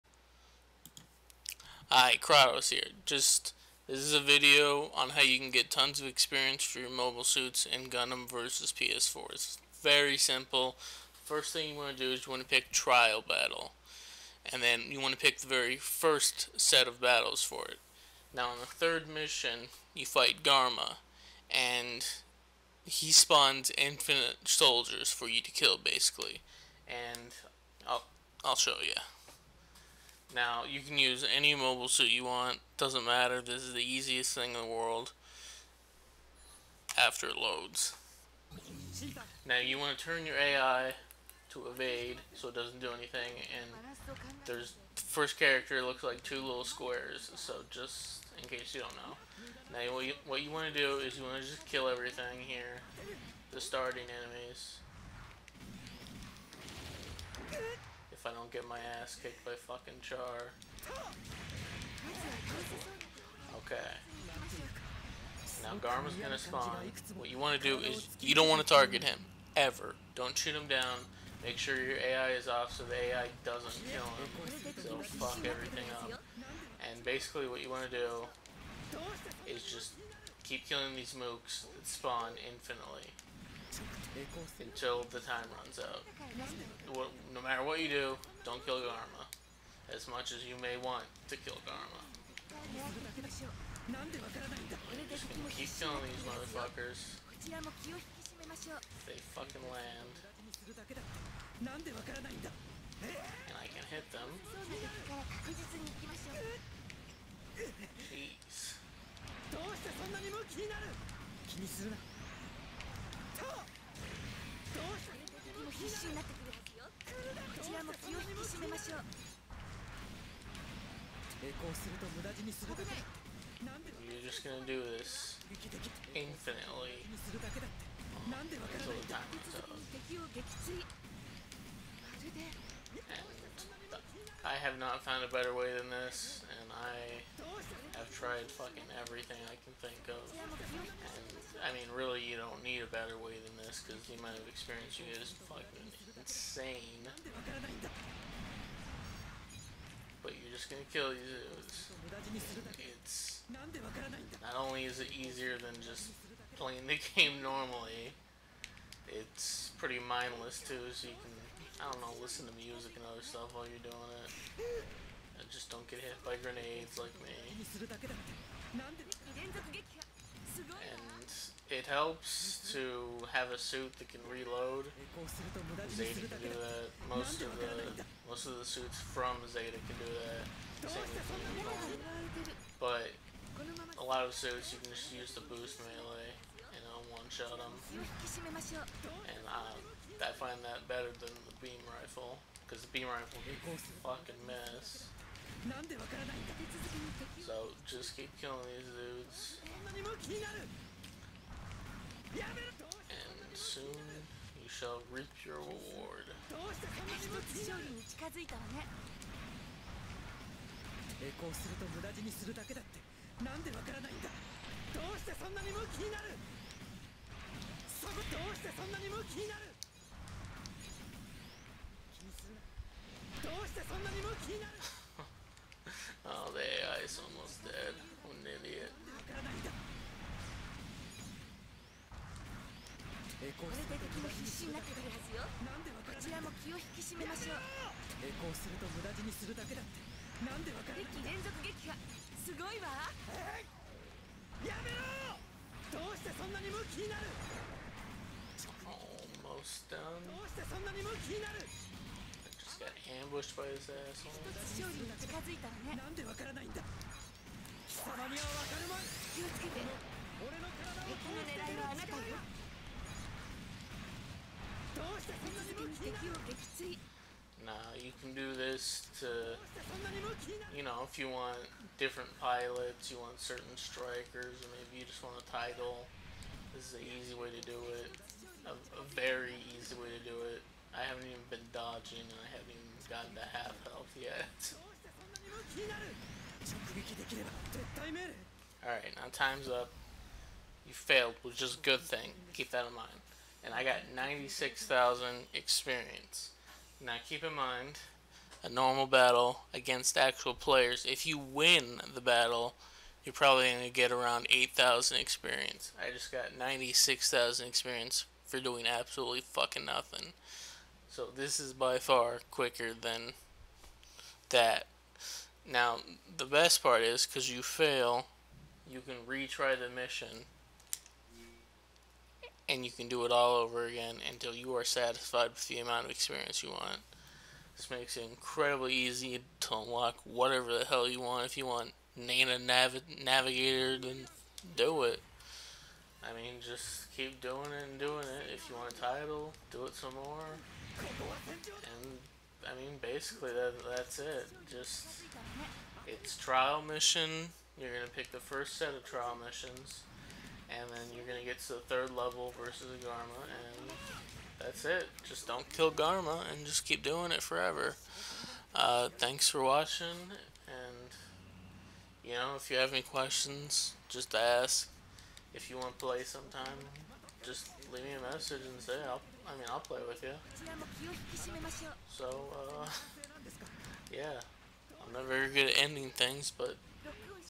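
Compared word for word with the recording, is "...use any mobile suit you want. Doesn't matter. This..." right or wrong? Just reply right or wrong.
right.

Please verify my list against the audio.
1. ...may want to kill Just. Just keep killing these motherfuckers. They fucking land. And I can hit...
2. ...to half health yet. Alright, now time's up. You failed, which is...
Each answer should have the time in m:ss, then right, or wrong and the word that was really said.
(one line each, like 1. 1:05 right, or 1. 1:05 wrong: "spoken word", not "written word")
1. 1:30 wrong: "Garma", not "Just"
2. 4:43 right.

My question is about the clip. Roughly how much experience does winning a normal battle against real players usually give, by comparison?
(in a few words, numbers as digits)
8,000.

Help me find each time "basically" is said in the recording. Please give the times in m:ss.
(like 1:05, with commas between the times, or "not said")
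0:25, 1:17, 5:43.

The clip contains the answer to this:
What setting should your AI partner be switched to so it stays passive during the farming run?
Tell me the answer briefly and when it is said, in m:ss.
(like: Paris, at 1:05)
evade, at 0:41.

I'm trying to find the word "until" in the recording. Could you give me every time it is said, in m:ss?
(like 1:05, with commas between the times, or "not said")
1:24, 2:07, 5:24.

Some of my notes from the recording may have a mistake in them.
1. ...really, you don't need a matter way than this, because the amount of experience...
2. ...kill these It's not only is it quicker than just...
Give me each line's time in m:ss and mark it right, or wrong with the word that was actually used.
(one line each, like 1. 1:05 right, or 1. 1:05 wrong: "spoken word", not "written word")
1. 2:21 wrong: "better", not "matter"
2. 2:30 wrong: "easier", not "quicker".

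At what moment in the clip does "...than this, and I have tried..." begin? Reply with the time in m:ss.
2:15.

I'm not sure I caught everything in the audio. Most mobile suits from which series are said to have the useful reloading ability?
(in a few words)
Zeta.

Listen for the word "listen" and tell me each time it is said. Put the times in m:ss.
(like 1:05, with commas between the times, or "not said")
2:42.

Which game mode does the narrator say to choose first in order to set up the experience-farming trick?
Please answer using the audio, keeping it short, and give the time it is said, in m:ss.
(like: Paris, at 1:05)
Trial Battle, at 0:12.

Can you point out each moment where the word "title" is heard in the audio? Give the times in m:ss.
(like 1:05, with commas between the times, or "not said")
4:35, 5:38.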